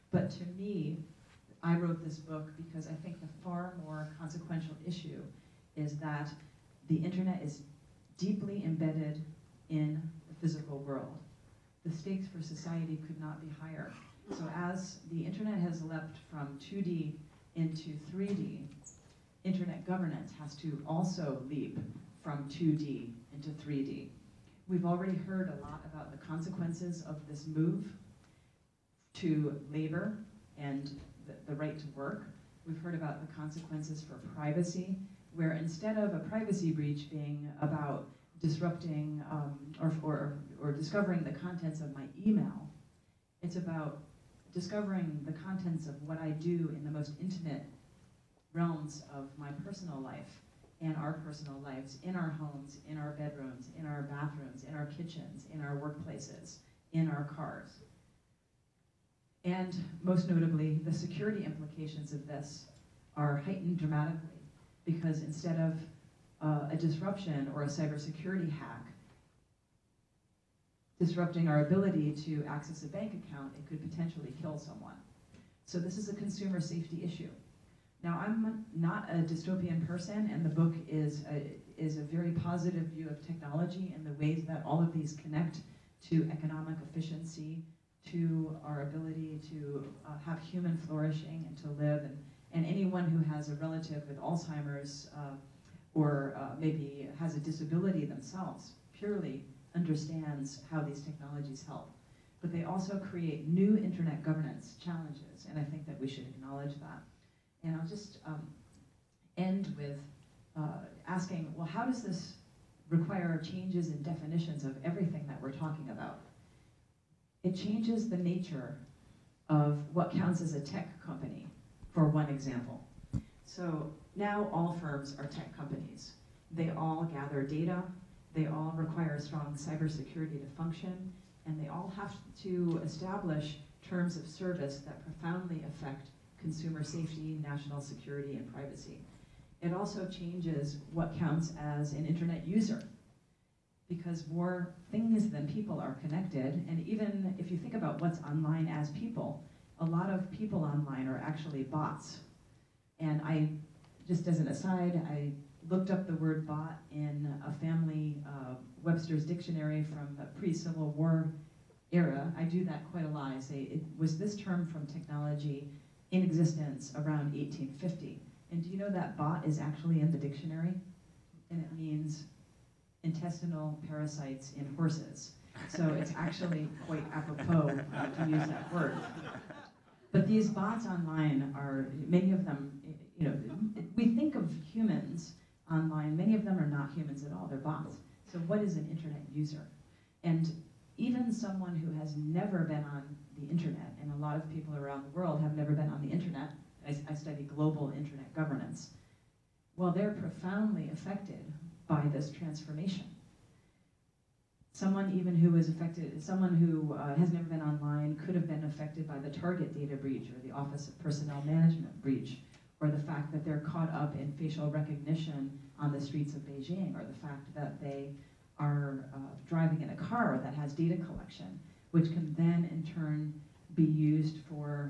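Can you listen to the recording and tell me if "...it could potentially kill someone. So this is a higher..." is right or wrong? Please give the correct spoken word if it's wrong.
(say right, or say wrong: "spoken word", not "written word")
wrong: "consumer", not "higher".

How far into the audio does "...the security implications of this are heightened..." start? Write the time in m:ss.
1:00.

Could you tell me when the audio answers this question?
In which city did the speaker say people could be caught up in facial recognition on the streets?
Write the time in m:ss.
3:36.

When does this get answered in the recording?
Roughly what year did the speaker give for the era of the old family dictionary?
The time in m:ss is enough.
2:47.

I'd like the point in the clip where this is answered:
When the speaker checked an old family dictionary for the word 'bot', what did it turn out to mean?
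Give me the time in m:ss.
2:53.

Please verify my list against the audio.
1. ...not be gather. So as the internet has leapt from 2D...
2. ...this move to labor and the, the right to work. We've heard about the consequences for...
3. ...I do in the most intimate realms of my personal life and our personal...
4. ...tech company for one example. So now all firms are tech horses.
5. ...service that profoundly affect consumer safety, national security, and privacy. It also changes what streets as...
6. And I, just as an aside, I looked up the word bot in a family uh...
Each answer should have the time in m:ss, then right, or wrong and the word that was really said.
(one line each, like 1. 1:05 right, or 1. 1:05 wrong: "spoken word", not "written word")
1. 0:13 wrong: "higher", not "gather"
2. 0:27 right
3. 0:46 right
4. 2:00 wrong: "companies", not "horses"
5. 2:14 wrong: "counts", not "streets"
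6. 2:32 right.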